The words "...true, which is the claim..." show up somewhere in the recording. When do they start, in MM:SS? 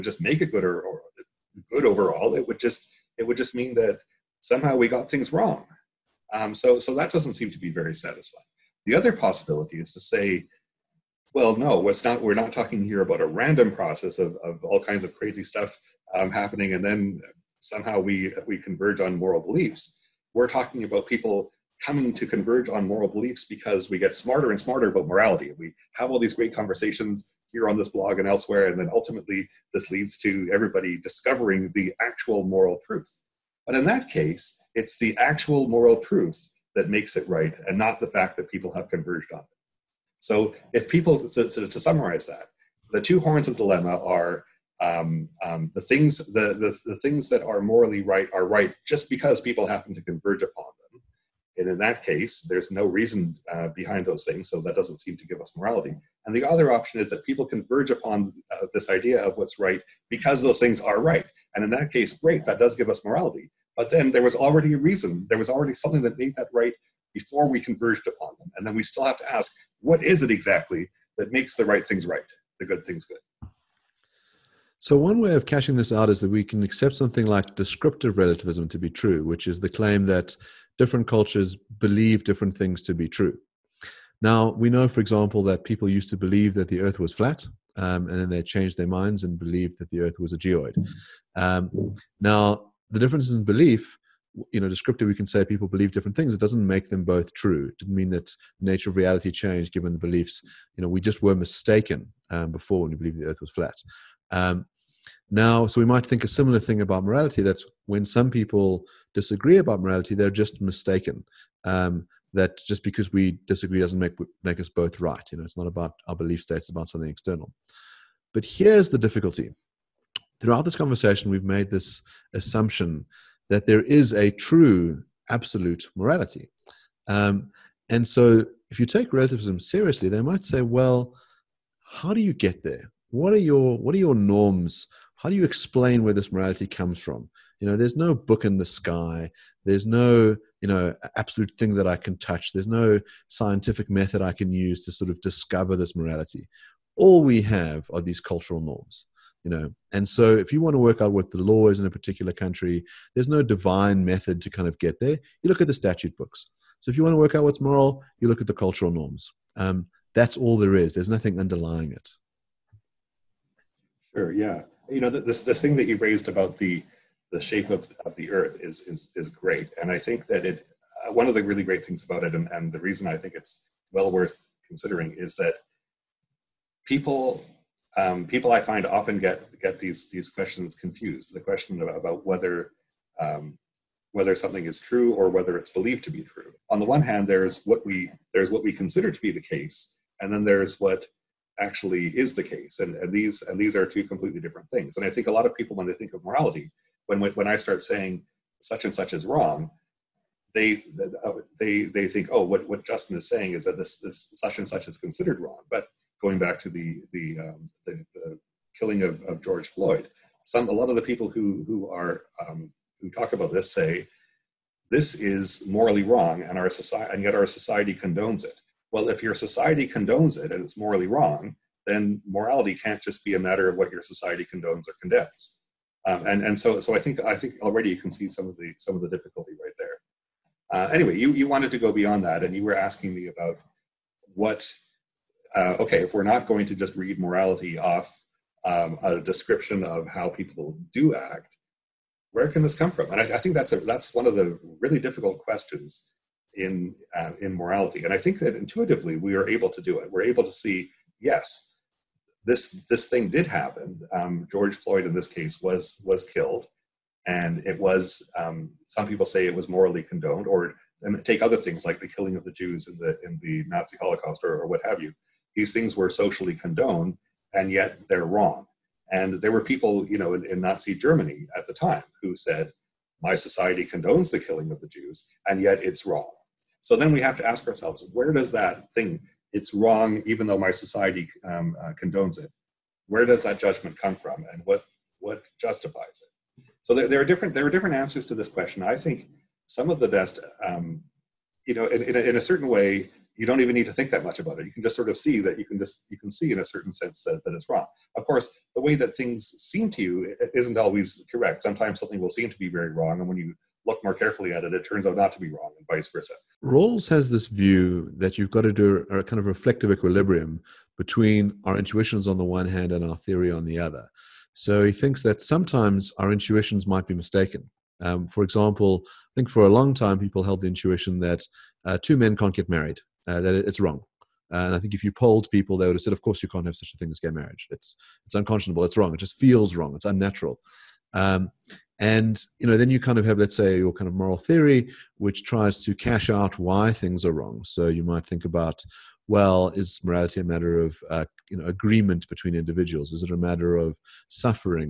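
01:18.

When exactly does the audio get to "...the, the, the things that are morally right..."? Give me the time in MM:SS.
00:46.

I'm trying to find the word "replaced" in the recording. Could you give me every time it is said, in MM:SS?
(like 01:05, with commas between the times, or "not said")
not said.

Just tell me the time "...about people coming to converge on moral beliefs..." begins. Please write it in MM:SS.
00:20.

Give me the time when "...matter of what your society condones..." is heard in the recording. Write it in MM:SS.
03:43.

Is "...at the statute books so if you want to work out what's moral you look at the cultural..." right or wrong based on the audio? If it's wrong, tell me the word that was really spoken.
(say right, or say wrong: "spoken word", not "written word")
right.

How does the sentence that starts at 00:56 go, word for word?
And the other option is that people converge upon uh, this idea of what's right because those things are right.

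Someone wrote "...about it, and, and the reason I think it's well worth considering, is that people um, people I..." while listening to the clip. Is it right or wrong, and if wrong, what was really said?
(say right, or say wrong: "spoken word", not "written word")
right.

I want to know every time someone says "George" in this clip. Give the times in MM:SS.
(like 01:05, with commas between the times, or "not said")
03:29, 04:14.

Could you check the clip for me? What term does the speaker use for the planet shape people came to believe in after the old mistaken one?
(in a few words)
geoid.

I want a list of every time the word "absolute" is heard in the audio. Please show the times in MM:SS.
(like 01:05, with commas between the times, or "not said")
02:05, 02:21.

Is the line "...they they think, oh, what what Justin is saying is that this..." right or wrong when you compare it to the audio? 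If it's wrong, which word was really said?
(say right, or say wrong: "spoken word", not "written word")
right.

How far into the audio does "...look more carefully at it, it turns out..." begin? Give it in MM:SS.
05:03.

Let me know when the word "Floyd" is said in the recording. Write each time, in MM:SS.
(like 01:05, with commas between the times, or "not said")
03:29, 04:14.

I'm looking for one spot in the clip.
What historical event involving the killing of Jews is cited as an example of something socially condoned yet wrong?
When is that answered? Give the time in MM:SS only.
04:23.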